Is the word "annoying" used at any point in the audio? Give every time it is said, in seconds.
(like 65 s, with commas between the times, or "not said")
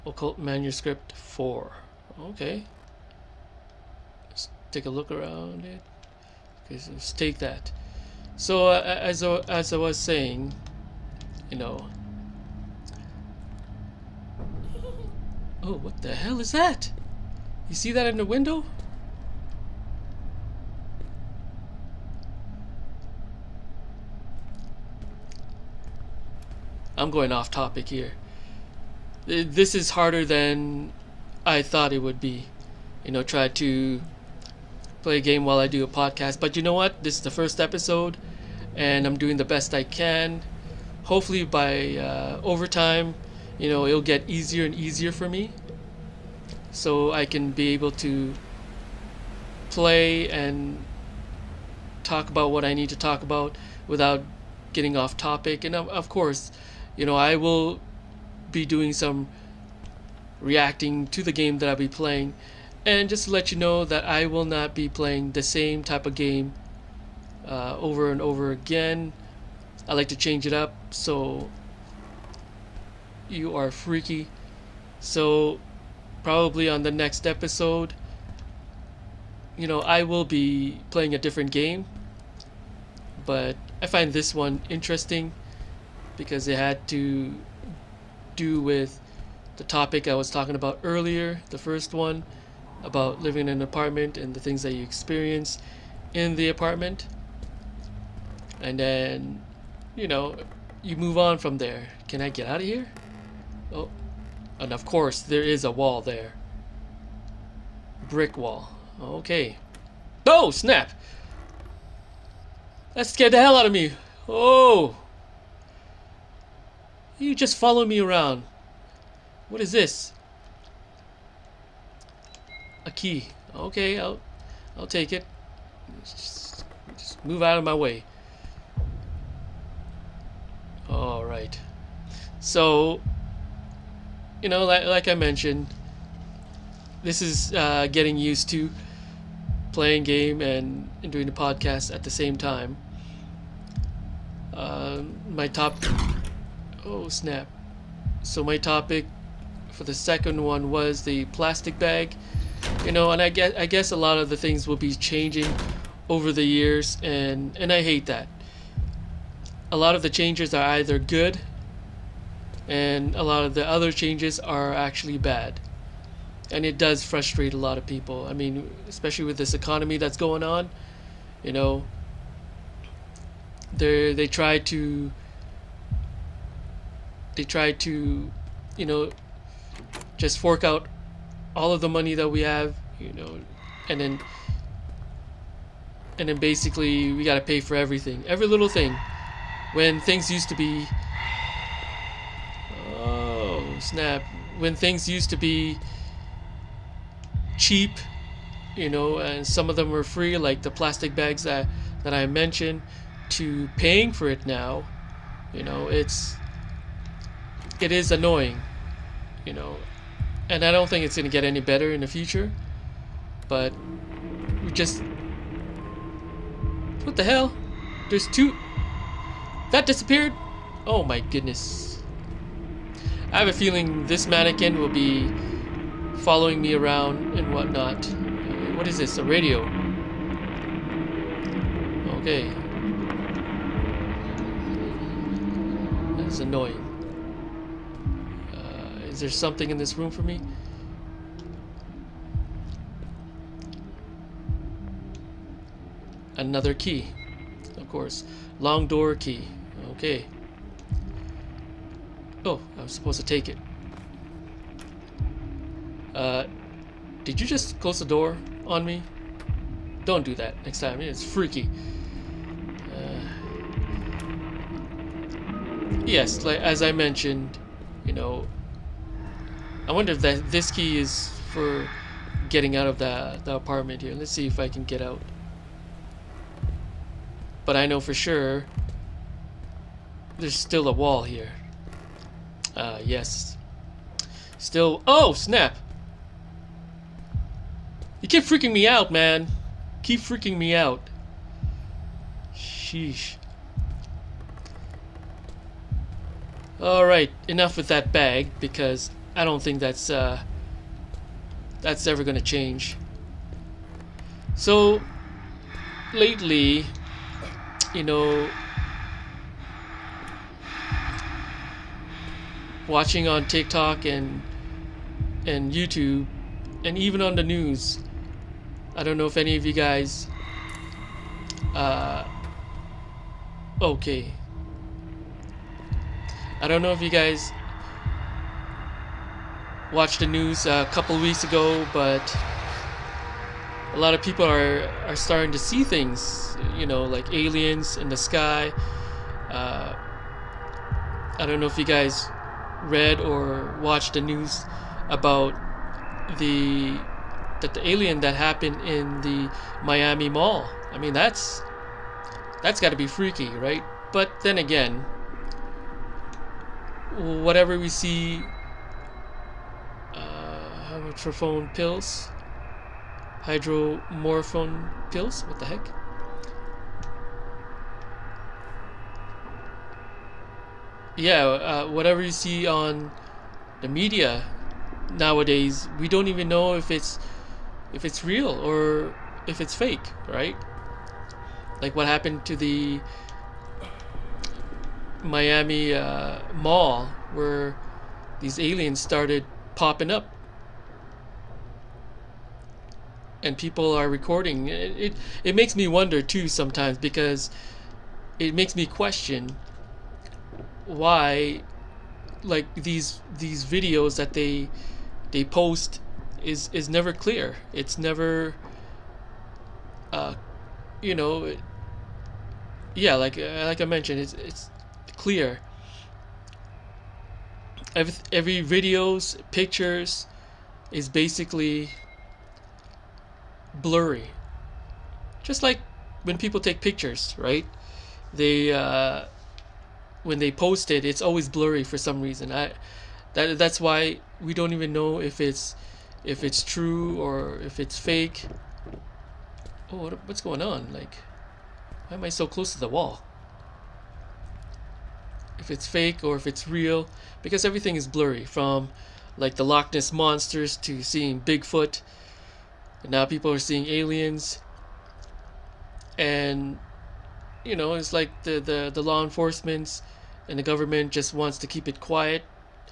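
208 s, 236 s.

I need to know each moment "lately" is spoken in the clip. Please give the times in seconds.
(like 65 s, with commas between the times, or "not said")
306 s.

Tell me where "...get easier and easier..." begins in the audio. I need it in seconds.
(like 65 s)
44 s.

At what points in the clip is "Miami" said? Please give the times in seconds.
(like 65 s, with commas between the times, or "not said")
349 s, 385 s.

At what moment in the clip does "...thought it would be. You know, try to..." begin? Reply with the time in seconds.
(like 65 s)
31 s.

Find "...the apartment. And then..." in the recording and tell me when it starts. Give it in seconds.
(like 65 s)
96 s.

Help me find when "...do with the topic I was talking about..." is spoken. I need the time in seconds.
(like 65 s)
88 s.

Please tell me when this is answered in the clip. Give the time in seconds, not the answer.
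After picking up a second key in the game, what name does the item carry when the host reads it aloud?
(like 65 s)
248 s.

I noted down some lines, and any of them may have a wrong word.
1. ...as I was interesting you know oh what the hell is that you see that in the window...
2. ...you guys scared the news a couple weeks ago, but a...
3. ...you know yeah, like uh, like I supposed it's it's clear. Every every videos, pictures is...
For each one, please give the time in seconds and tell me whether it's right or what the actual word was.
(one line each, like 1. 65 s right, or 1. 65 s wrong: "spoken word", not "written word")
1. 9 s wrong: "saying", not "interesting"
2. 327 s wrong: "watched", not "scared"
3. 411 s wrong: "mentioned", not "supposed".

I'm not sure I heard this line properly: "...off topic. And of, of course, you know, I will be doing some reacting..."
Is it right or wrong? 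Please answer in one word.
right.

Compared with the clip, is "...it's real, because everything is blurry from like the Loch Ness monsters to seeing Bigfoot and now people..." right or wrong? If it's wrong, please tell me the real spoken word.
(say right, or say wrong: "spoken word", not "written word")
right.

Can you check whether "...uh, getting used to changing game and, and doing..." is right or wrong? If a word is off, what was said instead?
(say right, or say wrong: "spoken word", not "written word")
wrong: "playing", not "changing".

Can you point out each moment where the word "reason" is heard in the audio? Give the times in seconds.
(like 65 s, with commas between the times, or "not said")
432 s.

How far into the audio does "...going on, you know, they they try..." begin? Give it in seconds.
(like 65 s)
170 s.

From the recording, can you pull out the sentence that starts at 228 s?
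Uh, what is this, a radio?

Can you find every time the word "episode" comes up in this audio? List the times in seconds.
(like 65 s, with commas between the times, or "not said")
37 s, 77 s.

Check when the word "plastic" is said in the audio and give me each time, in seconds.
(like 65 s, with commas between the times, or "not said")
151 s, 200 s.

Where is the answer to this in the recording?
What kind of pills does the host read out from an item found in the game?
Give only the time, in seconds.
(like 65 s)
363 s.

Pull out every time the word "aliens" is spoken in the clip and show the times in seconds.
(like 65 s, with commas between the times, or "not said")
337 s, 347 s, 388 s, 453 s.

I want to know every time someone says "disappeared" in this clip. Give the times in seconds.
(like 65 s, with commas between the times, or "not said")
219 s.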